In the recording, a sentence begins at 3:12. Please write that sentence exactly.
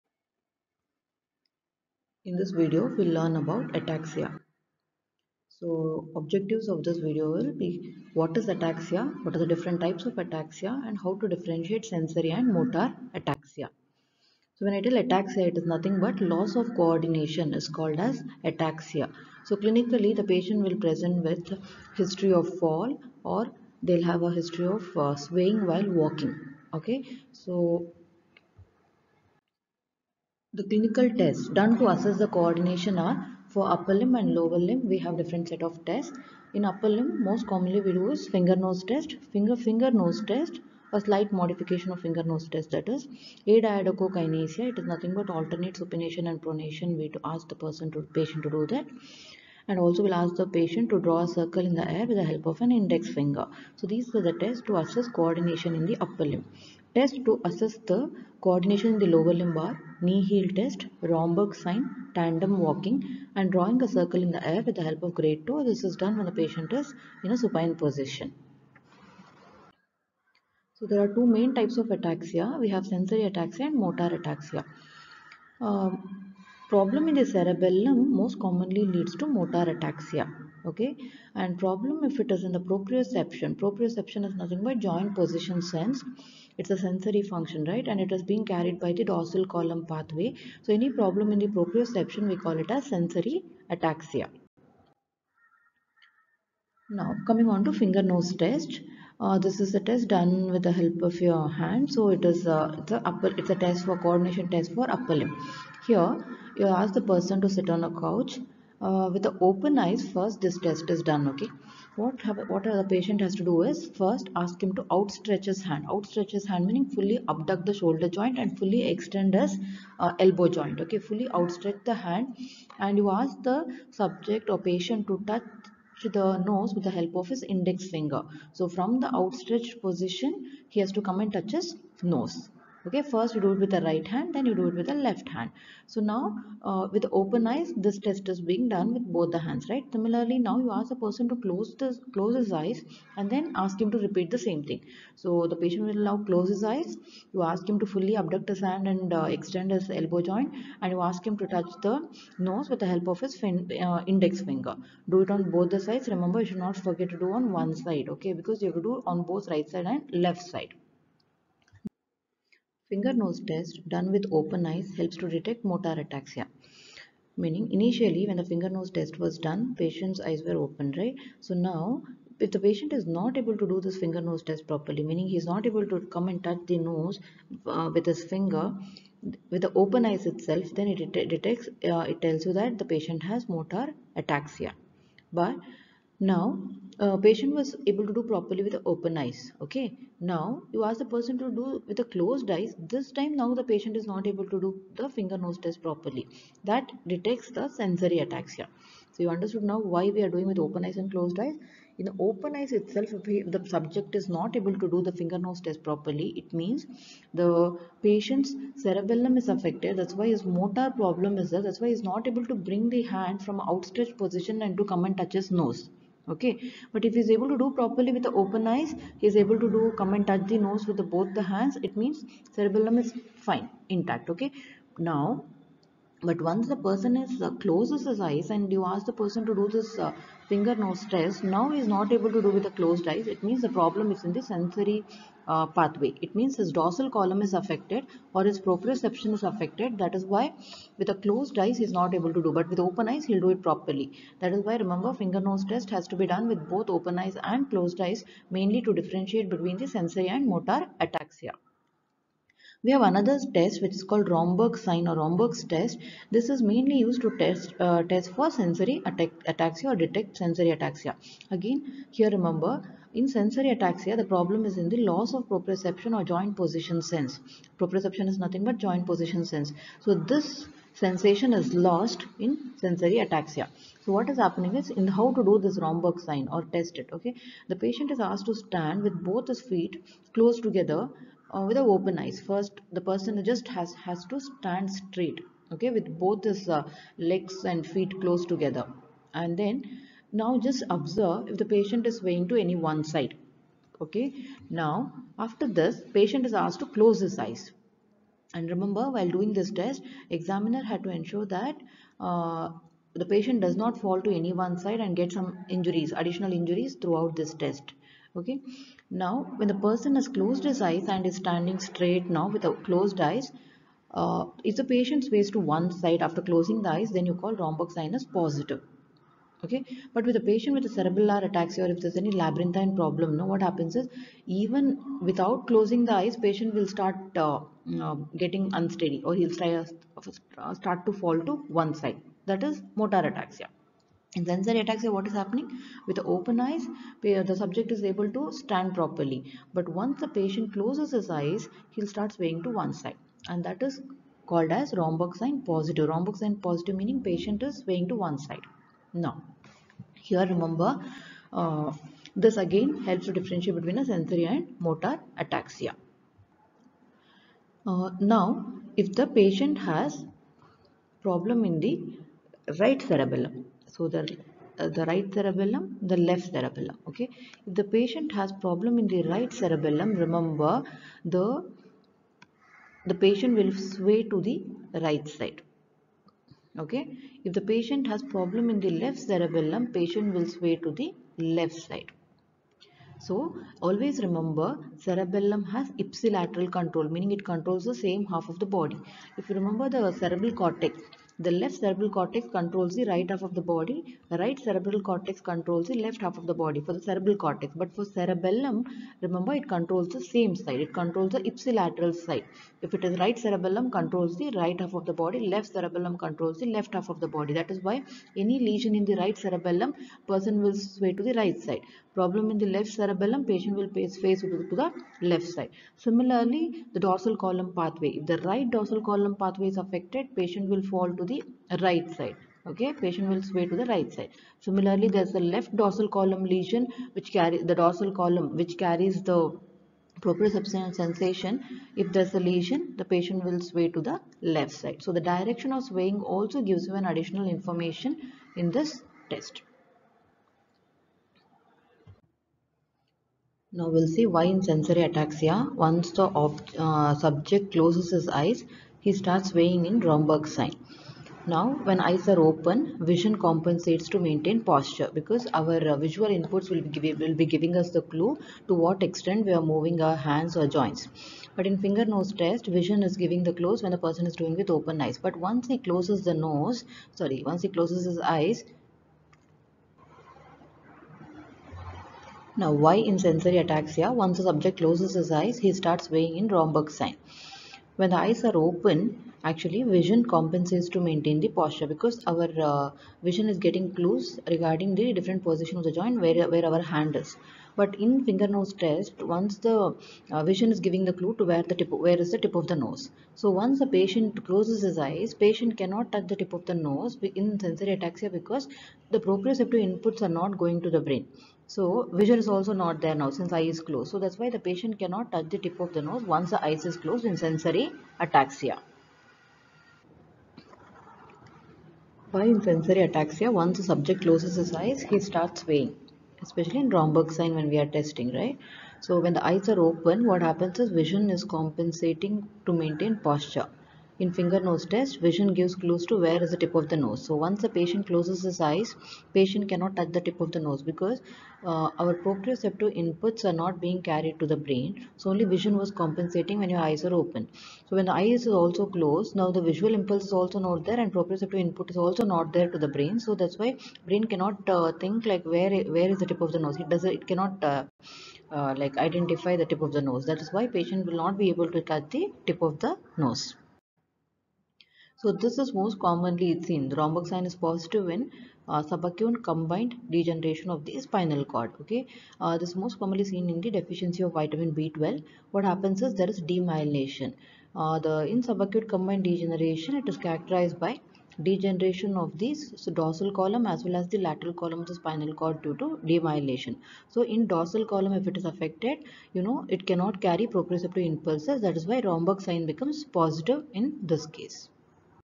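This time now the patient is not able to do the finger nose test properly.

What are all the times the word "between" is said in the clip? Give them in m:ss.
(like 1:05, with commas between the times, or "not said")
4:09, 5:53.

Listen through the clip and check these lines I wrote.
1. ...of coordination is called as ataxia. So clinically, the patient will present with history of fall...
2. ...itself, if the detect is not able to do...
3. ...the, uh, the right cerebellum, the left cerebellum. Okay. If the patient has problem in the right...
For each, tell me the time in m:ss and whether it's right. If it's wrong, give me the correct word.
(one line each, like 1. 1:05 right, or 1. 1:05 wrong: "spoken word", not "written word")
1. 0:16 right
2. 3:22 wrong: "subject", not "detect"
3. 6:04 right.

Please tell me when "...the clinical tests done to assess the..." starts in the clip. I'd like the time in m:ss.
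0:30.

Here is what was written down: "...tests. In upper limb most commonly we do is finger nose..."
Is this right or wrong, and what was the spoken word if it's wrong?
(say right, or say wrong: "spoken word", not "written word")
right.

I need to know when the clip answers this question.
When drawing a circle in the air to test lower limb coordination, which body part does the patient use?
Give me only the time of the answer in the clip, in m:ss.
1:05.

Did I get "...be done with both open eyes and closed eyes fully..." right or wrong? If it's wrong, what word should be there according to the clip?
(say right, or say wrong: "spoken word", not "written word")
wrong: "mainly", not "fully".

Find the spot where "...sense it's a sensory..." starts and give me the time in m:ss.
1:25.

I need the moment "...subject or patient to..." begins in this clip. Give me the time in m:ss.
2:03.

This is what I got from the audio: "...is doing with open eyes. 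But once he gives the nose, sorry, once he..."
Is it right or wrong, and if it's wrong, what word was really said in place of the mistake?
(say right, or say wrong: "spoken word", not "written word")
wrong: "closes", not "gives".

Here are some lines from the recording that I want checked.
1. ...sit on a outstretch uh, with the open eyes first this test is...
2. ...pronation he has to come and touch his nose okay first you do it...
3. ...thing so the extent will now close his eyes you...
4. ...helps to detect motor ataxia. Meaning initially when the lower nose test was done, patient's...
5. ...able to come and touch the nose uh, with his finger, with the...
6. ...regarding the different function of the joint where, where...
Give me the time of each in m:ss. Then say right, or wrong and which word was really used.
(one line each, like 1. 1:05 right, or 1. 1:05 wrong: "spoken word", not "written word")
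1. 1:47 wrong: "couch", not "outstretch"
2. 2:09 wrong: "position", not "pronation"
3. 2:24 wrong: "patient", not "extent"
4. 2:44 wrong: "finger", not "lower"
5. 2:55 right
6. 8:04 wrong: "position", not "function".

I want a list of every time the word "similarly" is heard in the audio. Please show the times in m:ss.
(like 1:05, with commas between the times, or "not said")
2:19, 6:55, 7:04.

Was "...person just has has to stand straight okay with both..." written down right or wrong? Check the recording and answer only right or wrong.
right.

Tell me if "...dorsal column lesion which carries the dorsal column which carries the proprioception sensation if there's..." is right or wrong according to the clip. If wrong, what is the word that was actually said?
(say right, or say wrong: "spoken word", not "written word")
right.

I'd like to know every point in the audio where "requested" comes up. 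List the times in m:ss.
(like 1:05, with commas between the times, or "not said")
not said.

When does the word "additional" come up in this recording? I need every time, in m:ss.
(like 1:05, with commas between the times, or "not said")
5:06, 7:17.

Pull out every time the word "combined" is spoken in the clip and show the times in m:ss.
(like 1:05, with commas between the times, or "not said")
9:19, 9:28.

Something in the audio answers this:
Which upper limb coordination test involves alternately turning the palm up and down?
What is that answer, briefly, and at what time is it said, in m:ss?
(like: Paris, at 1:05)
Adiadochokinesia, at 0:43.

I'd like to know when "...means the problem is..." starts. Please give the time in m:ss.
3:53.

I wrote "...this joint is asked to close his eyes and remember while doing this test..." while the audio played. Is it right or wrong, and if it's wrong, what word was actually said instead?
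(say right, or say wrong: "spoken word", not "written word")
wrong: "patient", not "joint".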